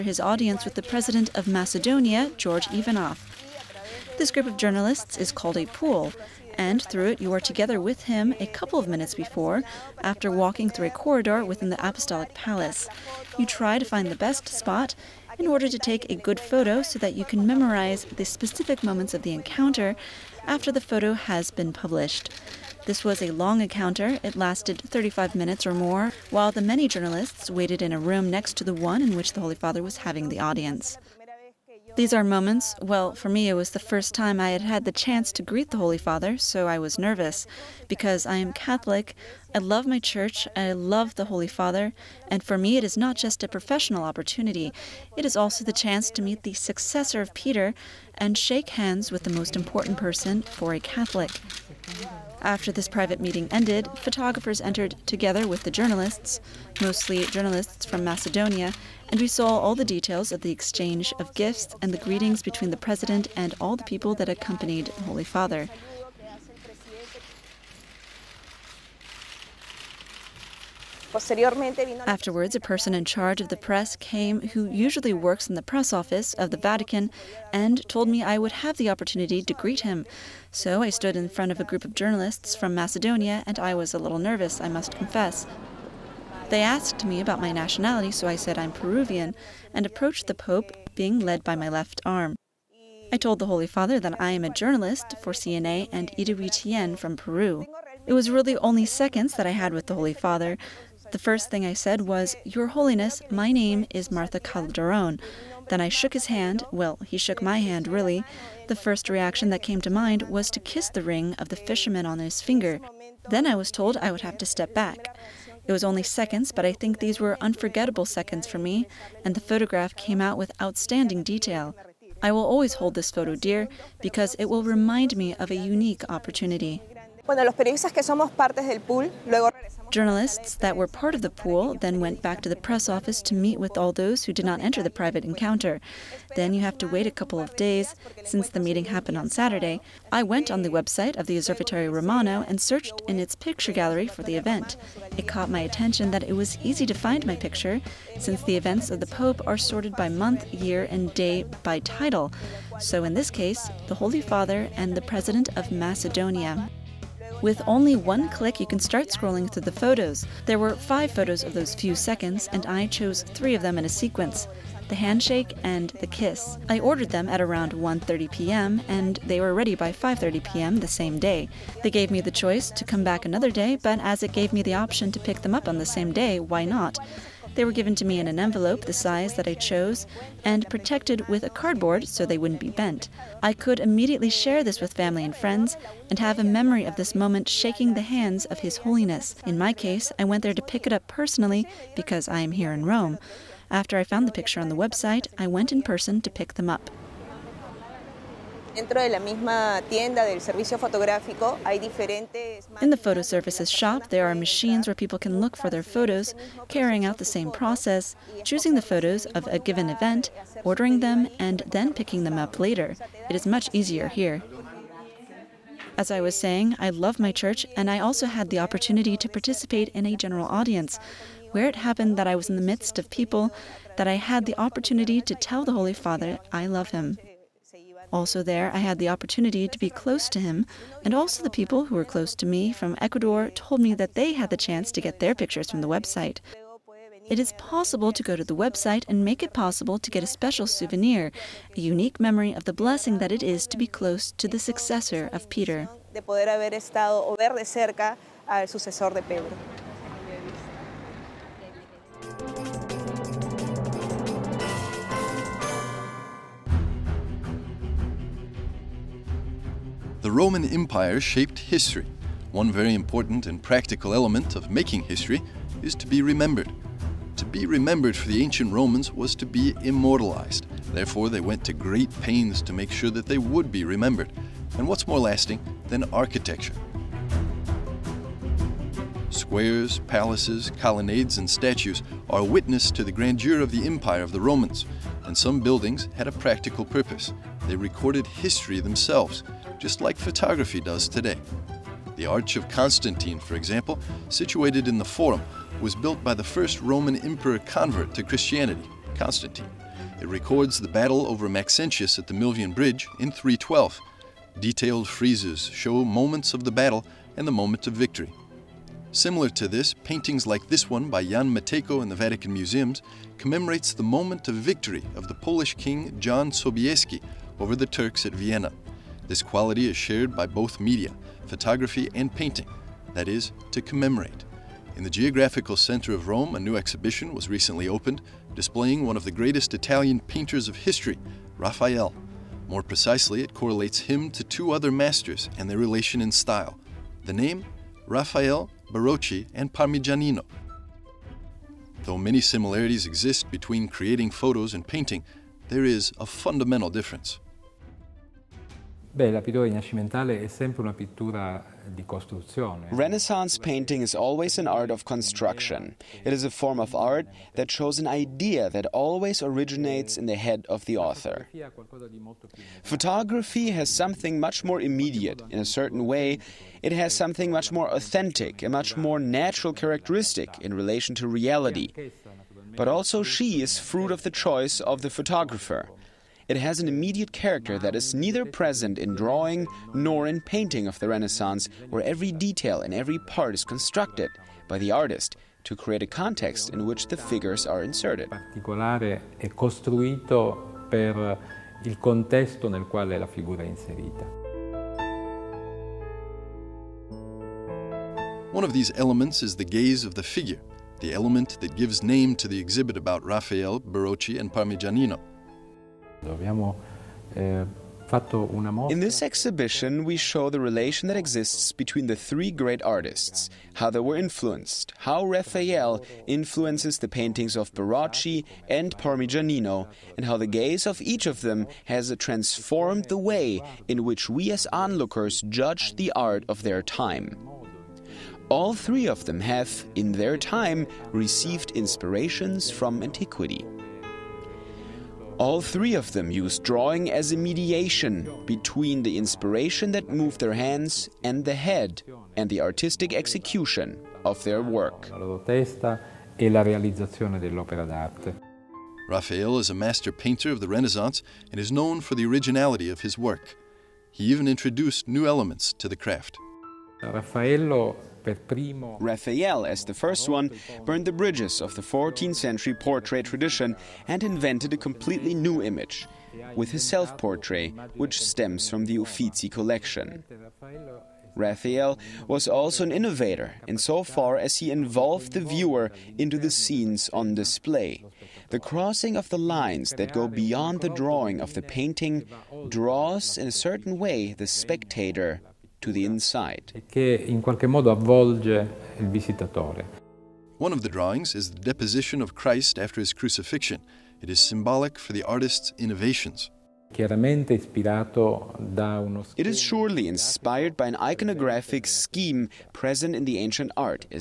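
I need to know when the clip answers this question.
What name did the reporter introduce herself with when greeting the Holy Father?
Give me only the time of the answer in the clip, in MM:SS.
01:44.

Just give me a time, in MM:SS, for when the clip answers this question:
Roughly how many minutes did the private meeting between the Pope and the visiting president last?
00:24.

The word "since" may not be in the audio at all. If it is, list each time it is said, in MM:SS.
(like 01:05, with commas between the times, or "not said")
02:18, 02:28.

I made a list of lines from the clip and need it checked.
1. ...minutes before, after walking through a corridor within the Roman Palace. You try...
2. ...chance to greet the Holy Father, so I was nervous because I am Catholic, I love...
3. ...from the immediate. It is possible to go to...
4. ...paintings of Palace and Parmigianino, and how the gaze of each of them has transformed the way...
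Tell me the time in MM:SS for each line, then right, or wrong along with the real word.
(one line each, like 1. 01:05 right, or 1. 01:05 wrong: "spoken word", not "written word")
1. 00:08 wrong: "Apostolic", not "Roman"
2. 00:34 right
3. 03:55 wrong: "website", not "immediate"
4. 06:57 wrong: "Barocci", not "Palace".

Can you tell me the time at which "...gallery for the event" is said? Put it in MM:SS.
02:23.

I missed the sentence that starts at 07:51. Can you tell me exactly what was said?
Raphael was also an innovator insofar as he involved the viewer into the scenes on display.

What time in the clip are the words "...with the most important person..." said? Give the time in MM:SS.
00:49.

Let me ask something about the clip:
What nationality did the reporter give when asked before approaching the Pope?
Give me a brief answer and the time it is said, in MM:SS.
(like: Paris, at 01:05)
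Peruvian, at 01:28.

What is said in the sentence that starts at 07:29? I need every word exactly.
Raphael is a master painter of the Renaissance and is known for the originality of his work.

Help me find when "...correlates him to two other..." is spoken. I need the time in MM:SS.
05:33.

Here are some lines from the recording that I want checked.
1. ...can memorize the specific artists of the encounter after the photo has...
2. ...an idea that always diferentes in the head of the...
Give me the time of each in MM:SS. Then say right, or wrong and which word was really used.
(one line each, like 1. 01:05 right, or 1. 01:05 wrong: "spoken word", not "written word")
1. 00:17 wrong: "moments", not "artists"
2. 05:57 wrong: "originates", not "diferentes".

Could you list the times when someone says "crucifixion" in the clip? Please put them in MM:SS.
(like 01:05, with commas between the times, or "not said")
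08:13.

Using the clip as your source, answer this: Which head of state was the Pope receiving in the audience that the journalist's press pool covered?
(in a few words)
George Ivanov.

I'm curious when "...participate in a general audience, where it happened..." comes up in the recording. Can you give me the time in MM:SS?
03:39.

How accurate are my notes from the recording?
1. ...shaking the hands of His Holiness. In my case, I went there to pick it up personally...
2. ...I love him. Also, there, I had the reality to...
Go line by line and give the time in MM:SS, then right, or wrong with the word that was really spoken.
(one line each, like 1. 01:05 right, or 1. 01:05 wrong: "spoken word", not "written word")
1. 03:07 right
2. 03:46 wrong: "opportunity", not "reality".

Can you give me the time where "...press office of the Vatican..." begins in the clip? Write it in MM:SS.
01:15.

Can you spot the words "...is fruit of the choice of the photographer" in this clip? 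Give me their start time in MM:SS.
06:13.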